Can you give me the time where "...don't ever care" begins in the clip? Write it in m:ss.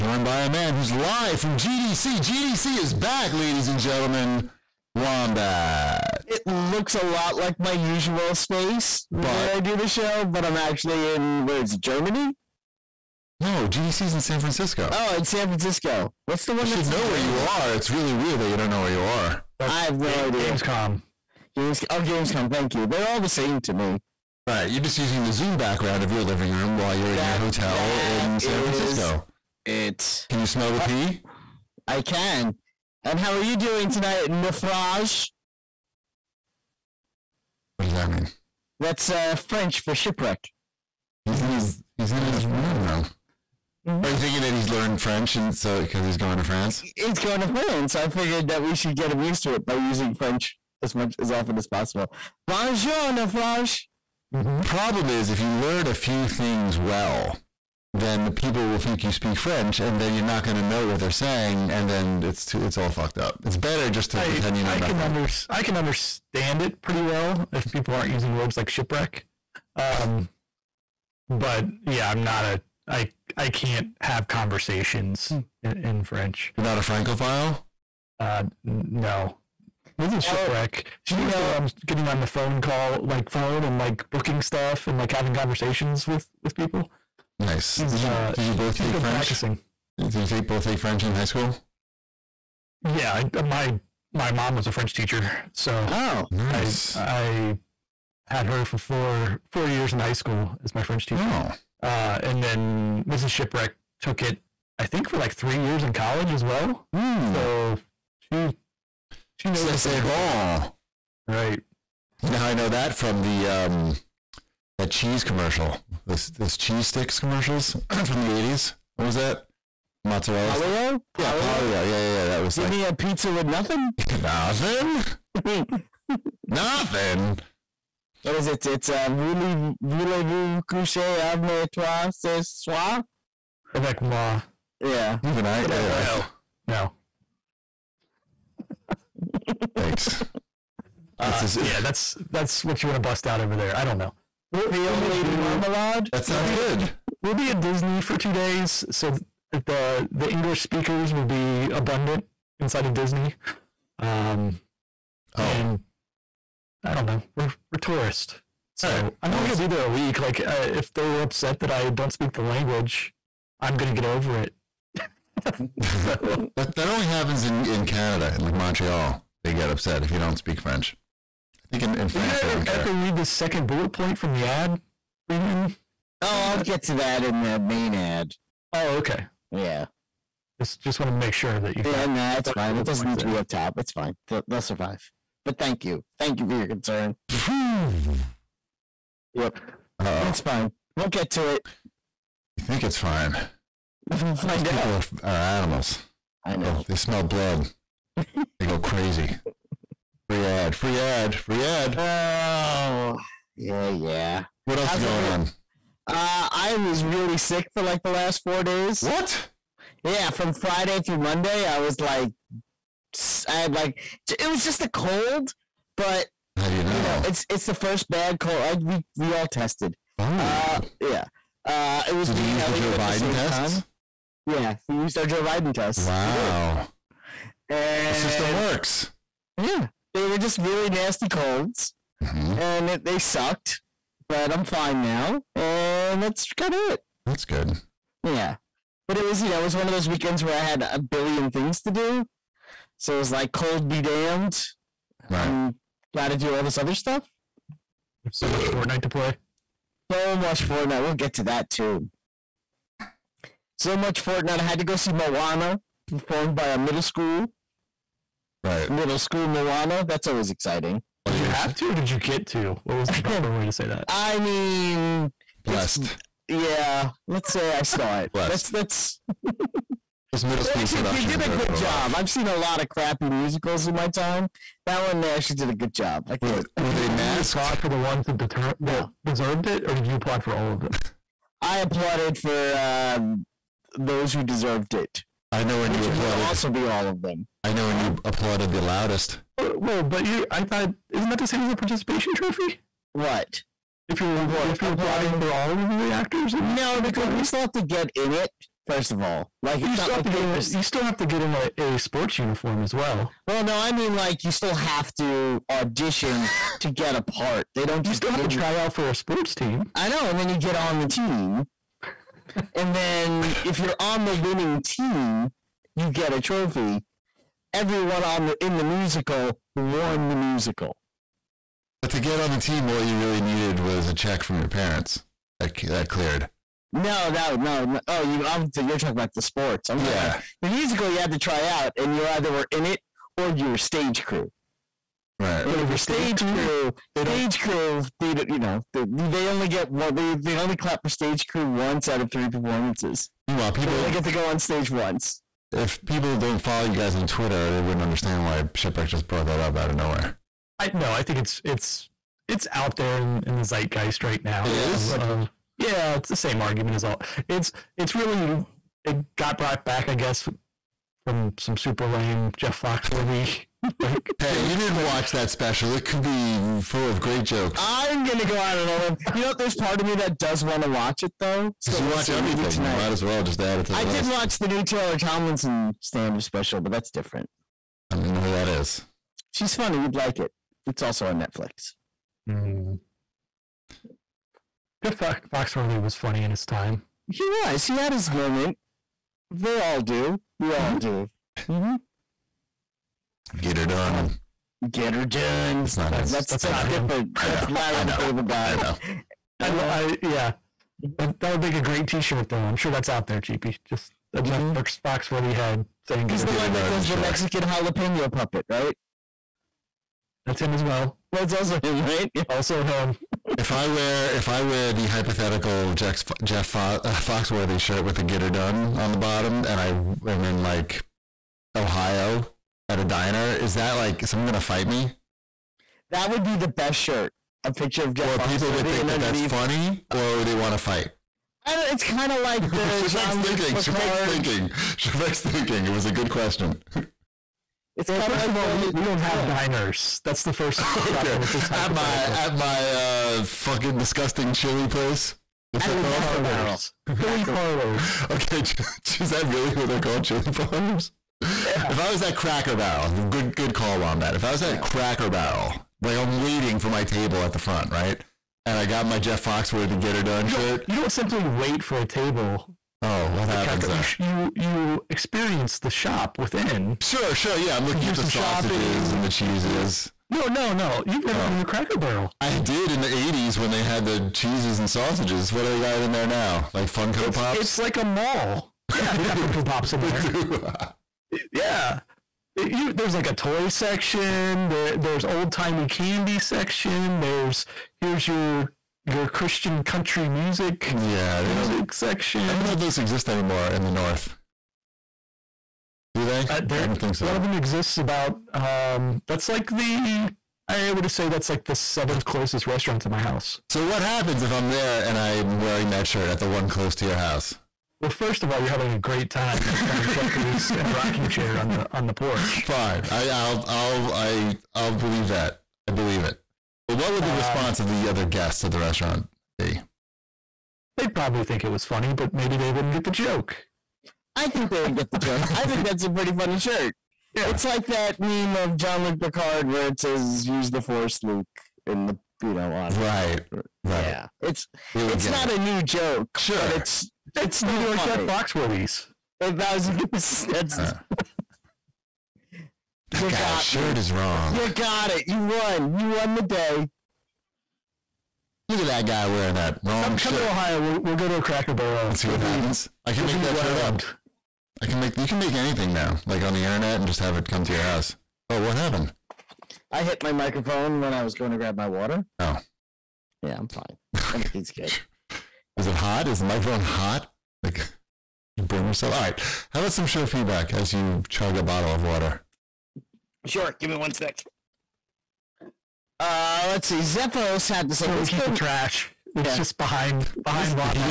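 2:52.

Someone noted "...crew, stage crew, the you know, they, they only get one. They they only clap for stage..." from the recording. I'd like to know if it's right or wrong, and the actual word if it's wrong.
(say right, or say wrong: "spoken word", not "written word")
right.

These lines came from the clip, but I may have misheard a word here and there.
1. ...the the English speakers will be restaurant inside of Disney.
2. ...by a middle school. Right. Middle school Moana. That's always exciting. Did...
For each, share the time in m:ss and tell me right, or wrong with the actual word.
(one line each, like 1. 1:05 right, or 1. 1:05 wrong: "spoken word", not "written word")
1. 2:29 wrong: "abundant", not "restaurant"
2. 4:16 right.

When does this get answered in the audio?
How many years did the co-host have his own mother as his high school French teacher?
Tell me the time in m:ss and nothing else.
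1:39.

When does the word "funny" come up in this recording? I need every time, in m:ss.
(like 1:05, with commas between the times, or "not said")
6:19, 6:26, 7:09, 8:41, 8:46.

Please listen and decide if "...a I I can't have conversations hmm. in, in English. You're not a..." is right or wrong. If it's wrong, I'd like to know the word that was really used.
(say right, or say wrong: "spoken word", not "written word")
wrong: "French", not "English".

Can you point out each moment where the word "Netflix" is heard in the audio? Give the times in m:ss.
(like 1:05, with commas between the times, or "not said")
6:21.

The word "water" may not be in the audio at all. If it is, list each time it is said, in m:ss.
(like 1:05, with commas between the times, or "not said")
9:21, 9:32.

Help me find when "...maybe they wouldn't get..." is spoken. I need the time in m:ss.
8:42.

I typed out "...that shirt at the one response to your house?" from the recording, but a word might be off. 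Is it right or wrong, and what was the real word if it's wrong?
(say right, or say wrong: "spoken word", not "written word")
wrong: "close", not "response".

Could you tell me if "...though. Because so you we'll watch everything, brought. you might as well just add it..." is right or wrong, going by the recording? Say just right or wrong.
wrong.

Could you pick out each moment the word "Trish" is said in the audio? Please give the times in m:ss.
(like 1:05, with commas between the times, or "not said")
not said.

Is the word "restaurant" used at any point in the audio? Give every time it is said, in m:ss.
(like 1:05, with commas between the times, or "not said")
8:22, 8:38.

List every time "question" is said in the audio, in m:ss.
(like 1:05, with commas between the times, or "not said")
7:16.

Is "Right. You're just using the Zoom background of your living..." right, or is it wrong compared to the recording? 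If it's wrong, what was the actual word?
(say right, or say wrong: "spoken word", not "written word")
right.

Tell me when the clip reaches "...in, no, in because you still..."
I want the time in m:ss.
4:56.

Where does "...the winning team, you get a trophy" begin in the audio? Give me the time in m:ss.
5:14.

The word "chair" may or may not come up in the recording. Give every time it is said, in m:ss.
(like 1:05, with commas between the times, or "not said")
8:31.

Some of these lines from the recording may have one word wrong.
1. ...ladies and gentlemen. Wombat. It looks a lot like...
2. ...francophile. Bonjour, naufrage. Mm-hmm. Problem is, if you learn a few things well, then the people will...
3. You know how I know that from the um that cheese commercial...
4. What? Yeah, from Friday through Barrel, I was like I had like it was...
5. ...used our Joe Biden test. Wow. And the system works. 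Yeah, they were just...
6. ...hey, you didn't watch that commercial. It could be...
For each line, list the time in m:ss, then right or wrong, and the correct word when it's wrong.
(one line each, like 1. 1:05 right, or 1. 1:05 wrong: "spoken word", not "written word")
1. 0:03 right
2. 0:51 wrong: "possible", not "francophile"
3. 1:52 right
4. 3:29 wrong: "Monday", not "Barrel"
5. 3:44 right
6. 6:04 wrong: "special", not "commercial".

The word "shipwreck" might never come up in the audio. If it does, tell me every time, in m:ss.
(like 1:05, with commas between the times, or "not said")
0:39, 1:08, 1:20, 1:43, 5:48.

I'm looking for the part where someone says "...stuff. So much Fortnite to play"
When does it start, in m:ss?
4:06.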